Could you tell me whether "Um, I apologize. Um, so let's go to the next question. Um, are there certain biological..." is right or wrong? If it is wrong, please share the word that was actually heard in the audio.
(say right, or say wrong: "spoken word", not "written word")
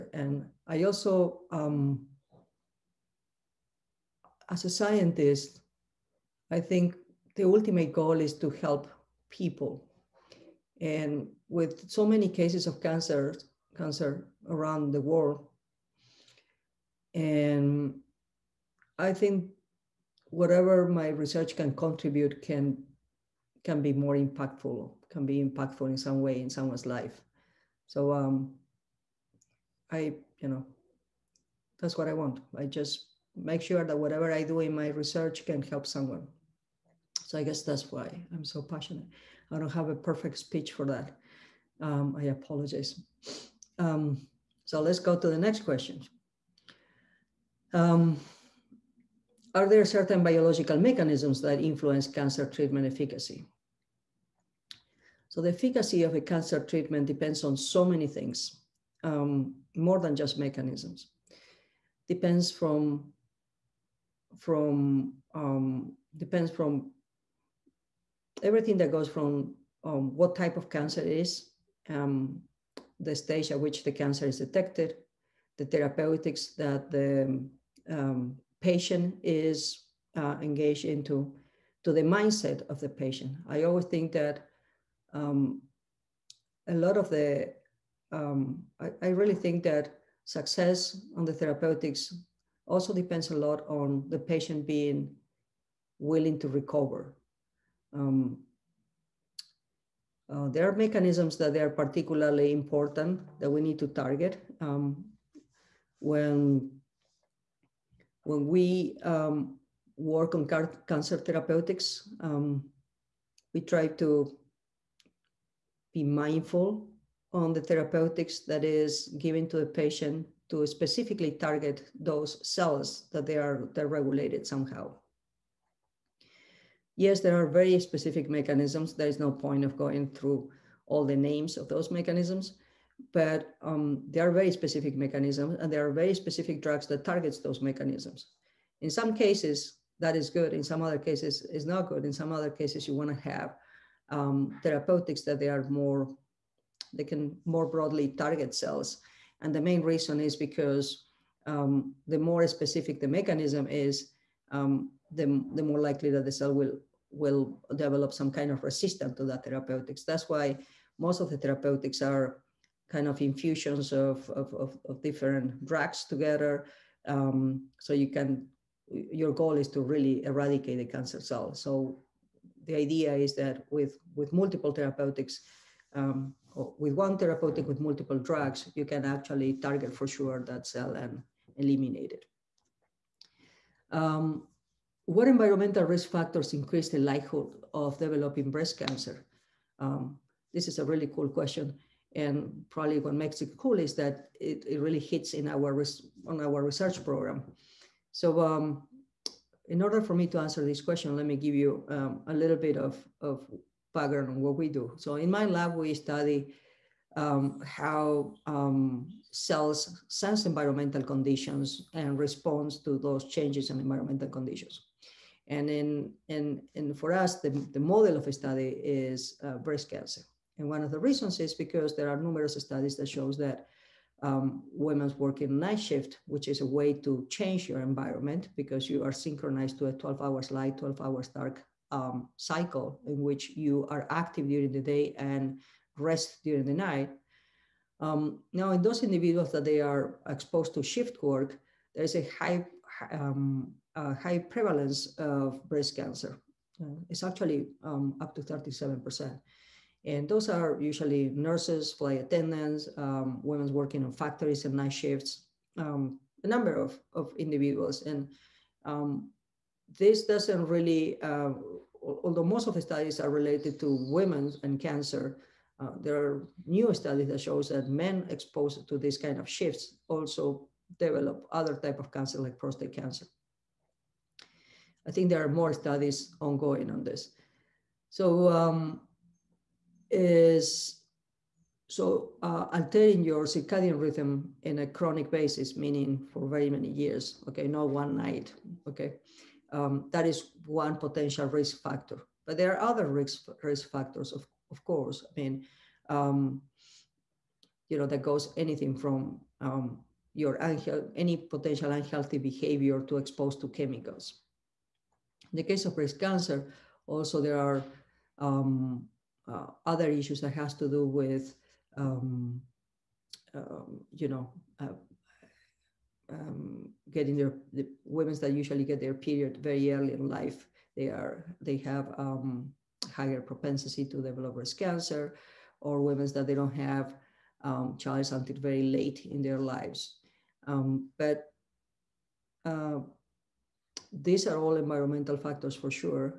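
right.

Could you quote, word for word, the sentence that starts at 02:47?
Um, so you can, your goal is to really eradicate the cancer cell.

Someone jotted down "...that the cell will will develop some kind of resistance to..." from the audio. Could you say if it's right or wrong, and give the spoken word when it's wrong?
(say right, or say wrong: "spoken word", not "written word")
right.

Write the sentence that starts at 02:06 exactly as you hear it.
Yes, there are very specific mechanisms.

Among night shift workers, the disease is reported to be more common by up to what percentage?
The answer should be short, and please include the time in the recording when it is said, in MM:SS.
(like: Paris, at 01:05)
37 percent, at 04:08.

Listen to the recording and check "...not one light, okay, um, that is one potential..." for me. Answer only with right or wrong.
wrong.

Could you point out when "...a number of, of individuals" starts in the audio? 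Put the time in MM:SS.
04:16.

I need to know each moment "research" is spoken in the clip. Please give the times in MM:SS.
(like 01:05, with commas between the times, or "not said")
00:21, 00:34, 03:16.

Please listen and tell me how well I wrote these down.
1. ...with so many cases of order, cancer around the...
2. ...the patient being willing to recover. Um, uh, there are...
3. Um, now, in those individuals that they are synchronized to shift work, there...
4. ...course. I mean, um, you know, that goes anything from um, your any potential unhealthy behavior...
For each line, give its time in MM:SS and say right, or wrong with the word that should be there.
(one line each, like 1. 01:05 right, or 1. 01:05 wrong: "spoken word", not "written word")
1. 00:11 wrong: "cancer", not "order"
2. 01:34 right
3. 03:57 wrong: "exposed", not "synchronized"
4. 04:54 right.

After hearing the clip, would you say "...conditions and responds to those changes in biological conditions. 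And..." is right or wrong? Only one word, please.
wrong.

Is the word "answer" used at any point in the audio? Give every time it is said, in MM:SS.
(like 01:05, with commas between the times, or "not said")
03:20.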